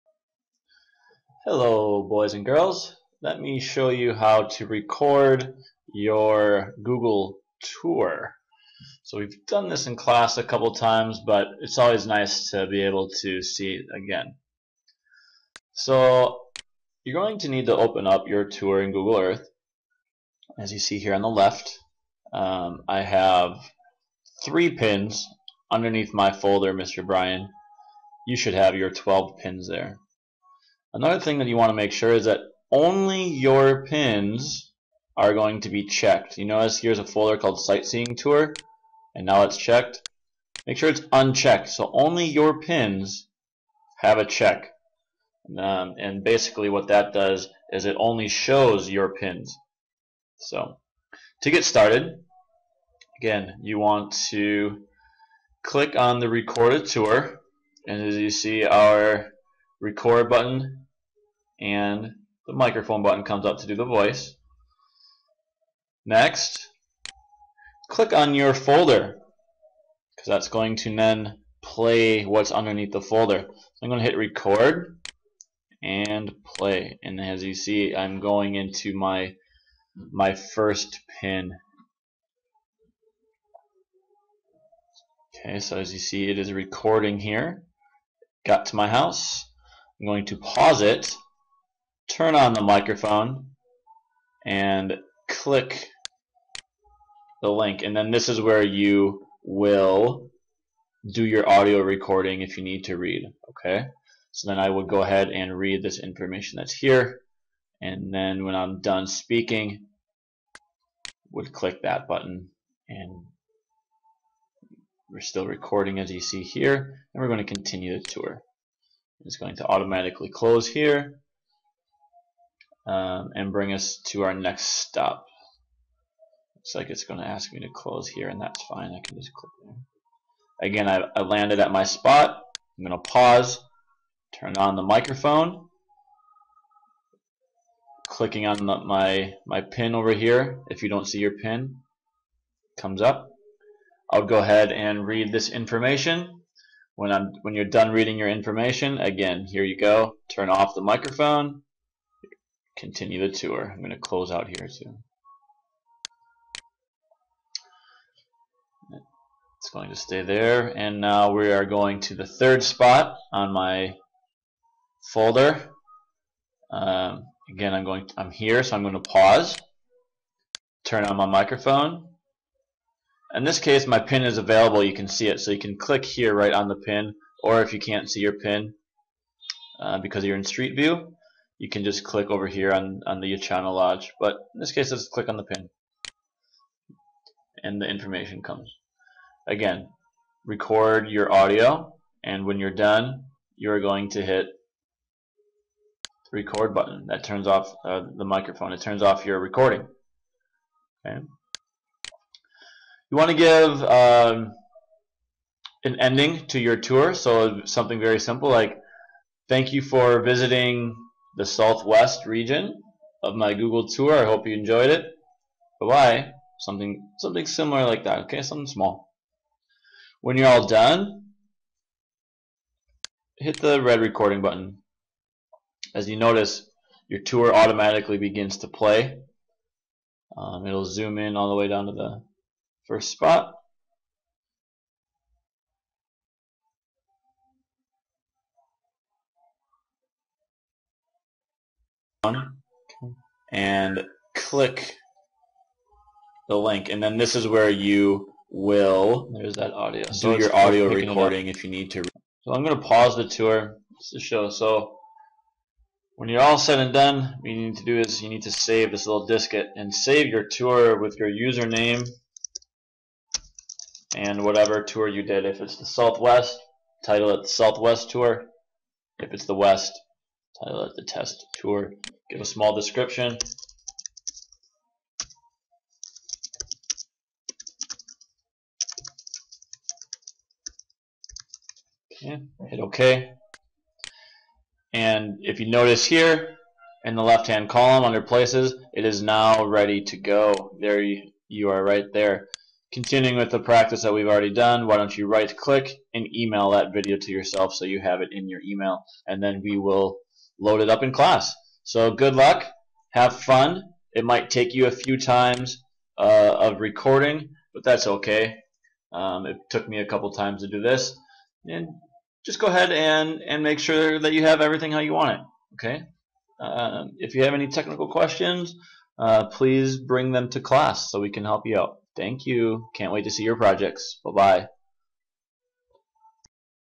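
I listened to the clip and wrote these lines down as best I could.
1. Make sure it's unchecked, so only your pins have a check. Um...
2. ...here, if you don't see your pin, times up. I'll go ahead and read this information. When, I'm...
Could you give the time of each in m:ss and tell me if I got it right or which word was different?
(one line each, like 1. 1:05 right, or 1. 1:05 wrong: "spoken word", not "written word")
1. 0:40 right
2. 2:20 wrong: "comes", not "times".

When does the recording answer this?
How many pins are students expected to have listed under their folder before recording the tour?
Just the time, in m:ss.
0:28.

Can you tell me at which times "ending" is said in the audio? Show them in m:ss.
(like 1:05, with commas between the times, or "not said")
3:25.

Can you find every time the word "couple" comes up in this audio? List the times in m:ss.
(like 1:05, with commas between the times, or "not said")
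0:10, 5:10.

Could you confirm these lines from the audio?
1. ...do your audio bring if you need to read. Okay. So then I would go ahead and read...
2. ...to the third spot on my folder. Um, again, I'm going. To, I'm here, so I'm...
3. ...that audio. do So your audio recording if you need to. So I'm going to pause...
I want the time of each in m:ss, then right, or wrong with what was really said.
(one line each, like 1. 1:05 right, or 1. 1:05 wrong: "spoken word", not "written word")
1. 1:41 wrong: "recording", not "bring"
2. 2:42 right
3. 4:09 right.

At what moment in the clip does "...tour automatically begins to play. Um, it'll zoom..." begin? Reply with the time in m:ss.
3:47.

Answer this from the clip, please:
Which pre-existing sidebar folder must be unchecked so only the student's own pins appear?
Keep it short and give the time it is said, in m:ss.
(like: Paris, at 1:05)
Sightseeing Tour, at 0:37.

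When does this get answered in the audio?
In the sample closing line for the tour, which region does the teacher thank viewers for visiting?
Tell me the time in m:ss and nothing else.
3:31.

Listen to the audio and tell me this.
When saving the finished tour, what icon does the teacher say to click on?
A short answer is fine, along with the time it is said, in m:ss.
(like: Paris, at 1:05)
diskette, at 4:19.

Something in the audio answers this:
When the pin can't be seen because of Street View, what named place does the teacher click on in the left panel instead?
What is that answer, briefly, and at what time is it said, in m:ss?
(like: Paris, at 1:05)
Channel Lodge, at 3:03.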